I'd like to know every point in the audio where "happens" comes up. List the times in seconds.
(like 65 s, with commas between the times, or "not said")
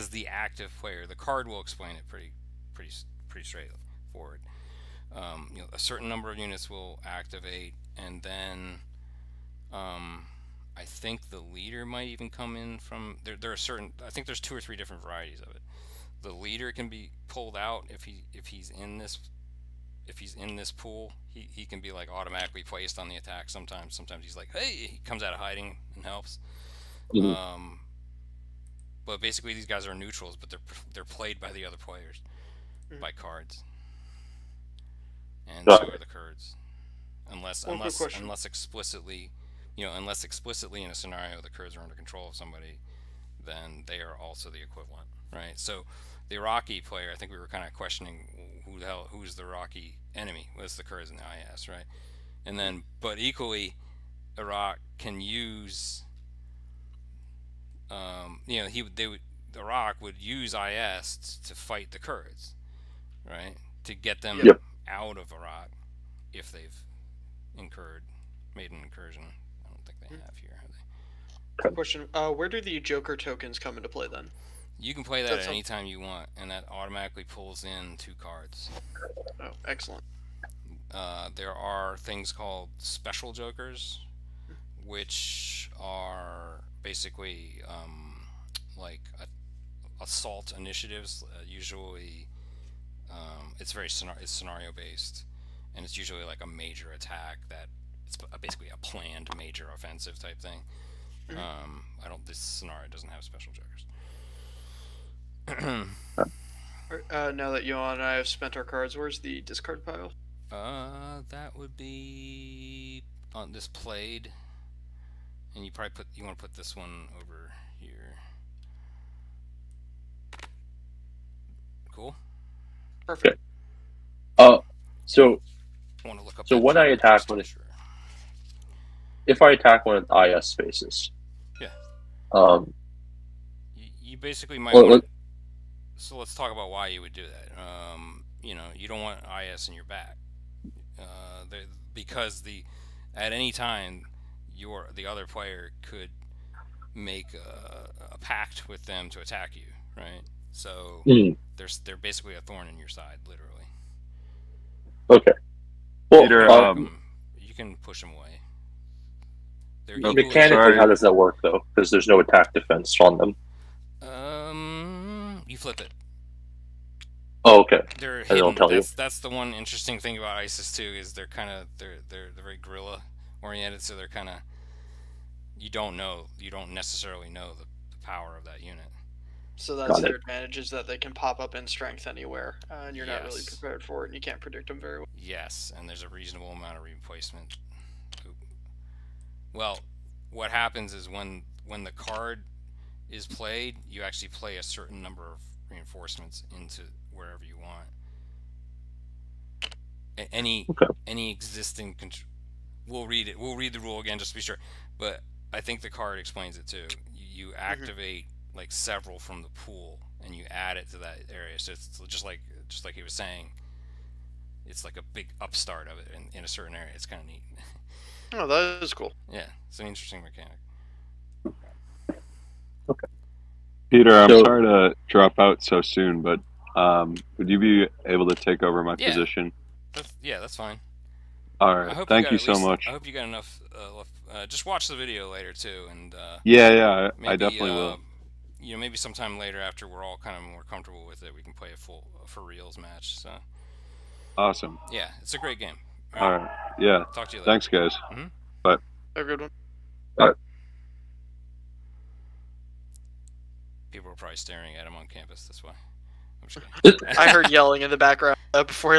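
190 s.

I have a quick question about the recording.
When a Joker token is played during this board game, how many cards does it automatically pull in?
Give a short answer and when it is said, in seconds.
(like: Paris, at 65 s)
2, at 77 s.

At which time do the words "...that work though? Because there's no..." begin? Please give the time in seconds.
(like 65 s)
161 s.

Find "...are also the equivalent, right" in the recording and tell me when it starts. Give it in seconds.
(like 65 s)
44 s.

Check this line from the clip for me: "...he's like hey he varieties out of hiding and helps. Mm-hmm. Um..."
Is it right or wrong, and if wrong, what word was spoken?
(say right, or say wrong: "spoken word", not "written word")
wrong: "comes", not "varieties".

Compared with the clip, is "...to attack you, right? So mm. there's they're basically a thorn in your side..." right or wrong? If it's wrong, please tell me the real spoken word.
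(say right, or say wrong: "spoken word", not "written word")
right.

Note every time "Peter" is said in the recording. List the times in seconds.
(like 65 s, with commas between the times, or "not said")
156 s, 223 s.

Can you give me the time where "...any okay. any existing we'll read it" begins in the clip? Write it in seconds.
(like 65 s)
200 s.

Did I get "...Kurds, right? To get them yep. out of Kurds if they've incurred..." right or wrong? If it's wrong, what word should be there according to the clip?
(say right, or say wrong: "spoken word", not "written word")
wrong: "Iraq", not "Kurds".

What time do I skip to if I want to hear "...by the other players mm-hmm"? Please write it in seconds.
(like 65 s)
31 s.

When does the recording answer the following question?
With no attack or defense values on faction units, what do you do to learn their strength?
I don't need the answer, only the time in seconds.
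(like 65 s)
165 s.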